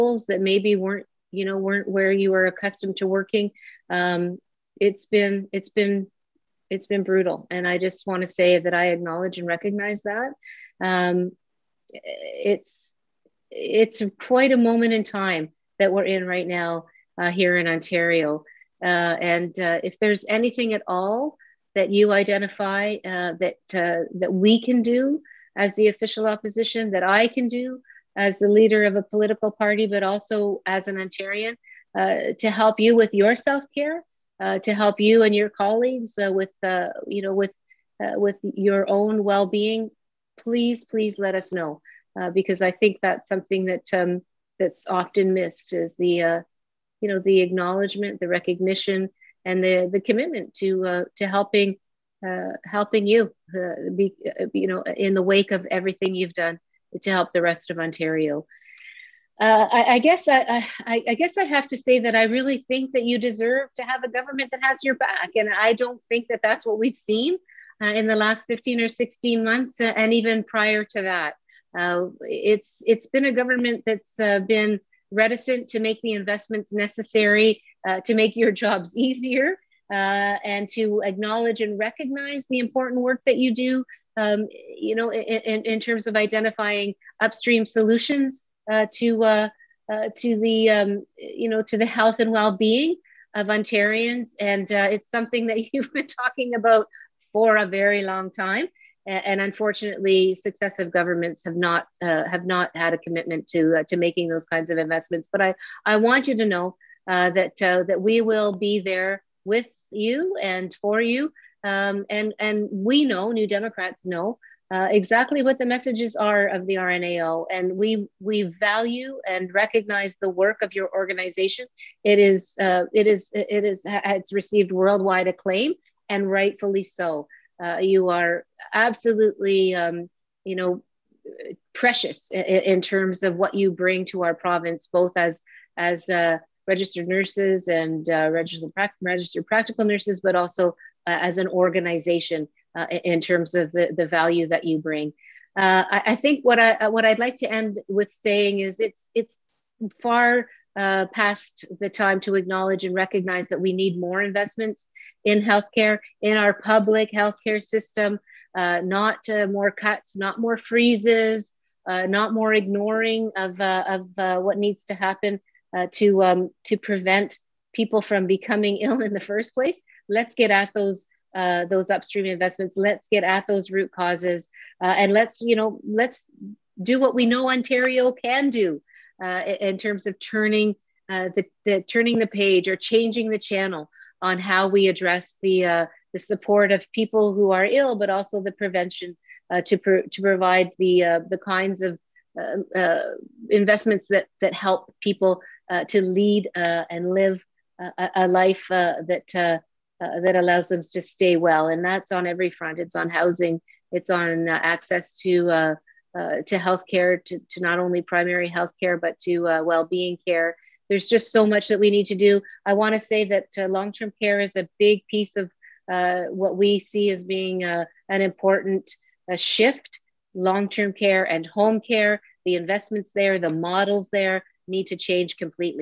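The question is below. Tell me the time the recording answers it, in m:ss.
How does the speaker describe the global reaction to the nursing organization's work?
2:04.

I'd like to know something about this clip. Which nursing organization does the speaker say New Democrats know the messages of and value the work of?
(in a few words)
RNAO.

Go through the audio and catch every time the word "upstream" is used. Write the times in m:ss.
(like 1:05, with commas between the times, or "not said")
1:27, 2:51.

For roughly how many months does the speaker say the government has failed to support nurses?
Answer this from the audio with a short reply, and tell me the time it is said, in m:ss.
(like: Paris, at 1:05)
15 or 16 months, at 1:08.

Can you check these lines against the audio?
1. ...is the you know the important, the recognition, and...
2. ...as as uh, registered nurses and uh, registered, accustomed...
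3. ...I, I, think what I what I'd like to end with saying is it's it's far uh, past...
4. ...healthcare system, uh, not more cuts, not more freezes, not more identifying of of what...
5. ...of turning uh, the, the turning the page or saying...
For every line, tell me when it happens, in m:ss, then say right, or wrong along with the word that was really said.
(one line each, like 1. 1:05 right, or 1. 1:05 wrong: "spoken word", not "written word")
1. 0:45 wrong: "acknowledgement", not "important"
2. 2:15 wrong: "registered", not "accustomed"
3. 2:25 right
4. 2:37 wrong: "ignoring", not "identifying"
5. 3:00 wrong: "changing", not "saying".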